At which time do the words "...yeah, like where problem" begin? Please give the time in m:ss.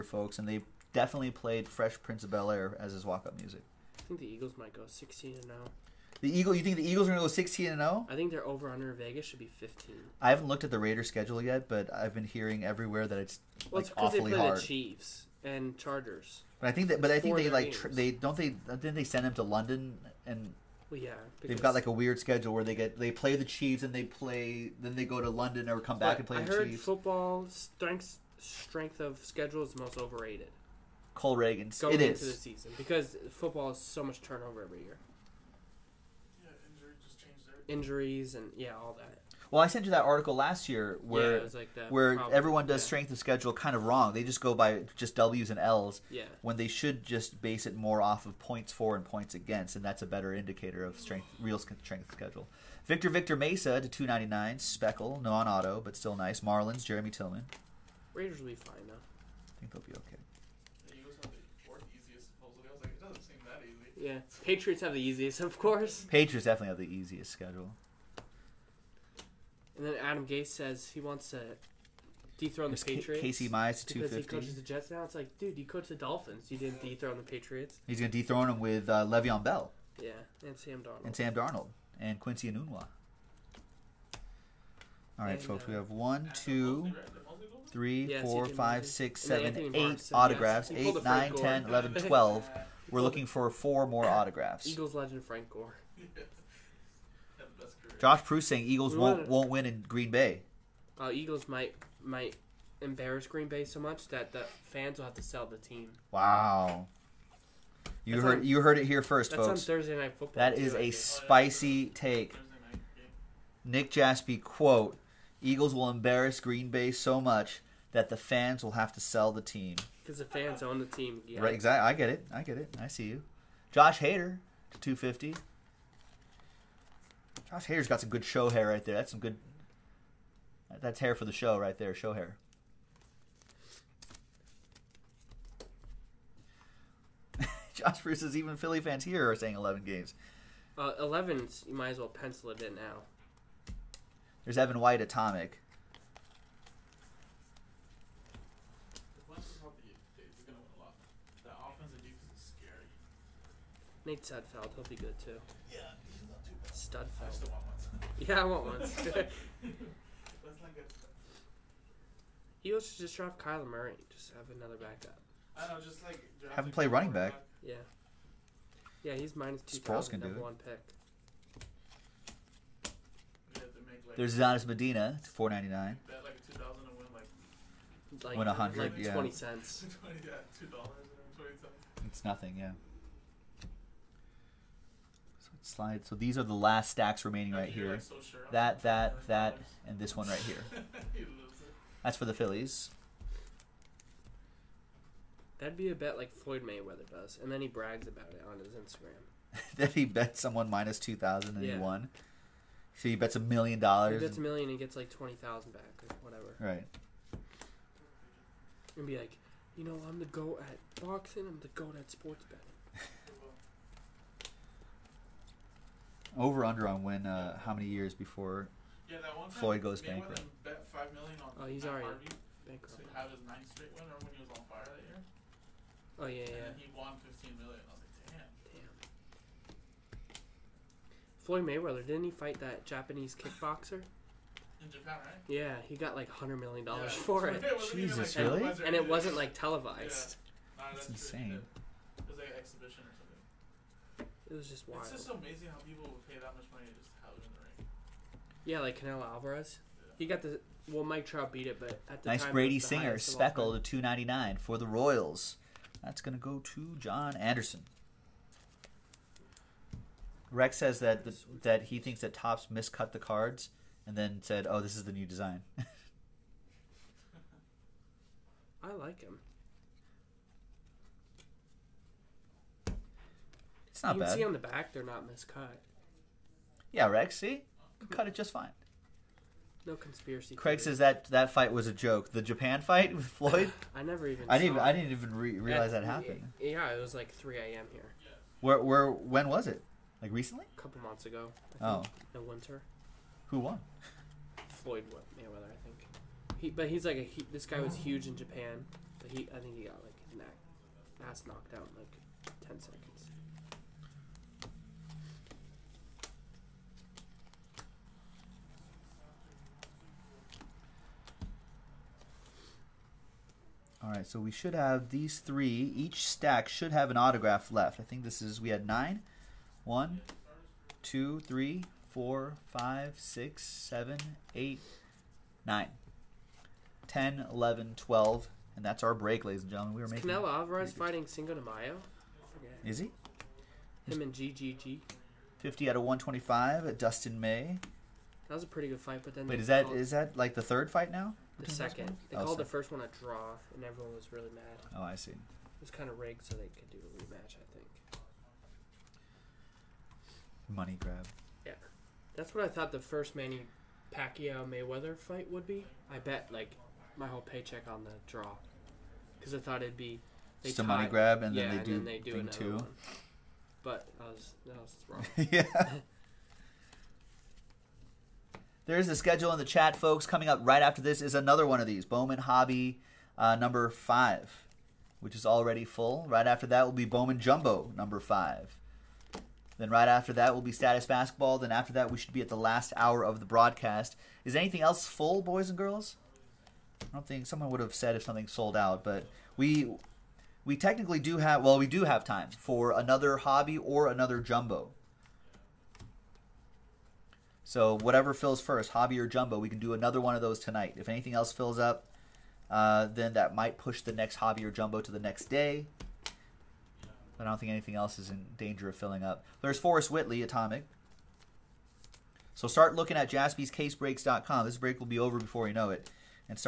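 0:41.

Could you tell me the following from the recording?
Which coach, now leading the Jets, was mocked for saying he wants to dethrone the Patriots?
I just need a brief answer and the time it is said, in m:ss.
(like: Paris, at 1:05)
Adam Gase, at 1:10.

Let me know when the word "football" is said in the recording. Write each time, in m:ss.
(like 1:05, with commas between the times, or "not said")
0:26, 0:33, 1:50.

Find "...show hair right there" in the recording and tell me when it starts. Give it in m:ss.
2:08.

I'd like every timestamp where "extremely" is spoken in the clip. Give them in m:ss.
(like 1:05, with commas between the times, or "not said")
not said.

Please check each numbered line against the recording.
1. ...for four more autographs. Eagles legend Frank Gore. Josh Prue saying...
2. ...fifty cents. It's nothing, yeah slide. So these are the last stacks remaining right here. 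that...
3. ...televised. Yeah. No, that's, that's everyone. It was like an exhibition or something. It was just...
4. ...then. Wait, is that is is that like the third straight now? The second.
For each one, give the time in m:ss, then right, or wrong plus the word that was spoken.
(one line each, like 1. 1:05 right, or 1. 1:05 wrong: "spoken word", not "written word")
1. 1:33 right
2. 3:01 wrong: "twenty", not "fifty"
3. 3:59 wrong: "insane", not "everyone"
4. 5:39 wrong: "fight", not "straight".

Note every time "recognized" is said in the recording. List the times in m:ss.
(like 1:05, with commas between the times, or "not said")
not said.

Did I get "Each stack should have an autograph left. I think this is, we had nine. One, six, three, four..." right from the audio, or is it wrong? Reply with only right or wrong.
wrong.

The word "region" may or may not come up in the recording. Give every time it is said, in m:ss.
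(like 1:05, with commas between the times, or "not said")
not said.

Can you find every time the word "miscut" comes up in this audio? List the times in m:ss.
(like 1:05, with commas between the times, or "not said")
4:22, 4:35.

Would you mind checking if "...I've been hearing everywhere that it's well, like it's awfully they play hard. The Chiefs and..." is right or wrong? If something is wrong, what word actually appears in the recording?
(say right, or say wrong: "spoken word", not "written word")
right.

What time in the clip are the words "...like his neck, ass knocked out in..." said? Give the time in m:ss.
5:00.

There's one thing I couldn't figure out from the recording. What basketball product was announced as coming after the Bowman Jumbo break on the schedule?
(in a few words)
Status Basketball.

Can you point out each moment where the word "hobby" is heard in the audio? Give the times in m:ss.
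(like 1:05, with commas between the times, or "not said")
6:12, 6:33, 6:38, 6:44.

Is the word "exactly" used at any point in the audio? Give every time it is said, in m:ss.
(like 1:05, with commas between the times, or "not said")
2:01.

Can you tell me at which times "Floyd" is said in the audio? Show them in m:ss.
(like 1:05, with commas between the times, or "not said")
3:16, 3:39, 3:51, 4:43, 4:54.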